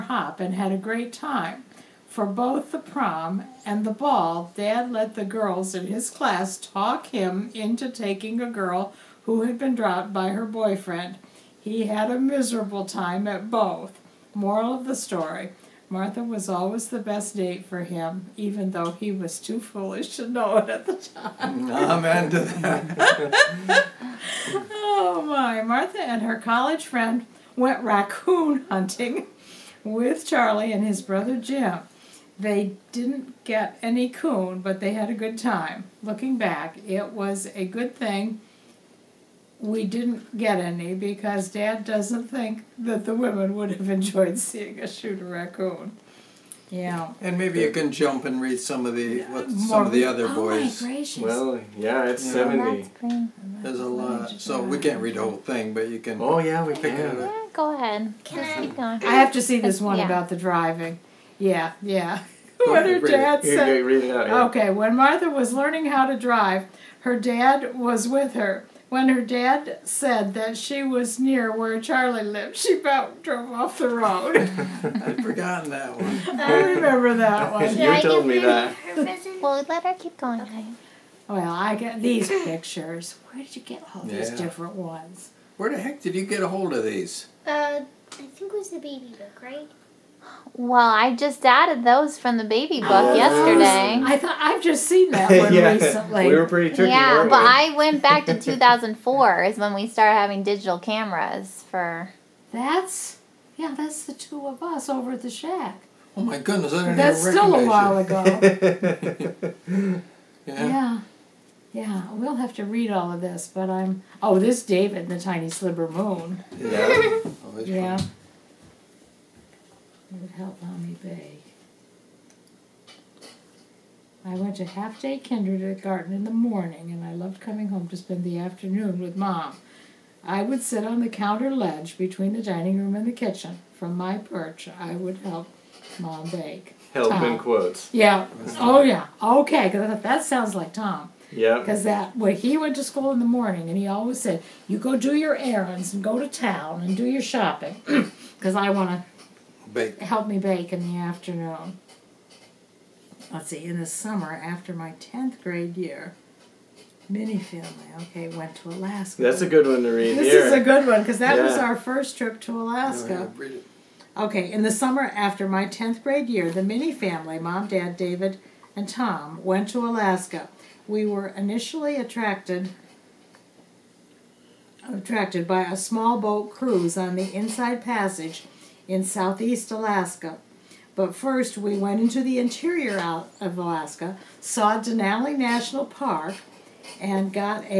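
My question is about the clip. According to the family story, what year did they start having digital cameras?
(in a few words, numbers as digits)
2004.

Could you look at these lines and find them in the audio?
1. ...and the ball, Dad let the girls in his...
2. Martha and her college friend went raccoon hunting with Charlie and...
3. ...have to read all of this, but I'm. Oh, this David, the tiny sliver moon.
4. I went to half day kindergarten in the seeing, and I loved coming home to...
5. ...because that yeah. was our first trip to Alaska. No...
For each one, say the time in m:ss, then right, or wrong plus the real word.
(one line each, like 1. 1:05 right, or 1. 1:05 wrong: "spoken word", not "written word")
1. 0:03 right
2. 0:25 right
3. 1:52 right
4. 2:04 wrong: "morning", not "seeing"
5. 2:41 right.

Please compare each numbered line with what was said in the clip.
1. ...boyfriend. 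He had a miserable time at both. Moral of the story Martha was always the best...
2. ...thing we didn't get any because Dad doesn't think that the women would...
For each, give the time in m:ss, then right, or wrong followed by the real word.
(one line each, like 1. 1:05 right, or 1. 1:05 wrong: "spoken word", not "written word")
1. 0:10 right
2. 0:37 right.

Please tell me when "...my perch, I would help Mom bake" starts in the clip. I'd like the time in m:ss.
2:13.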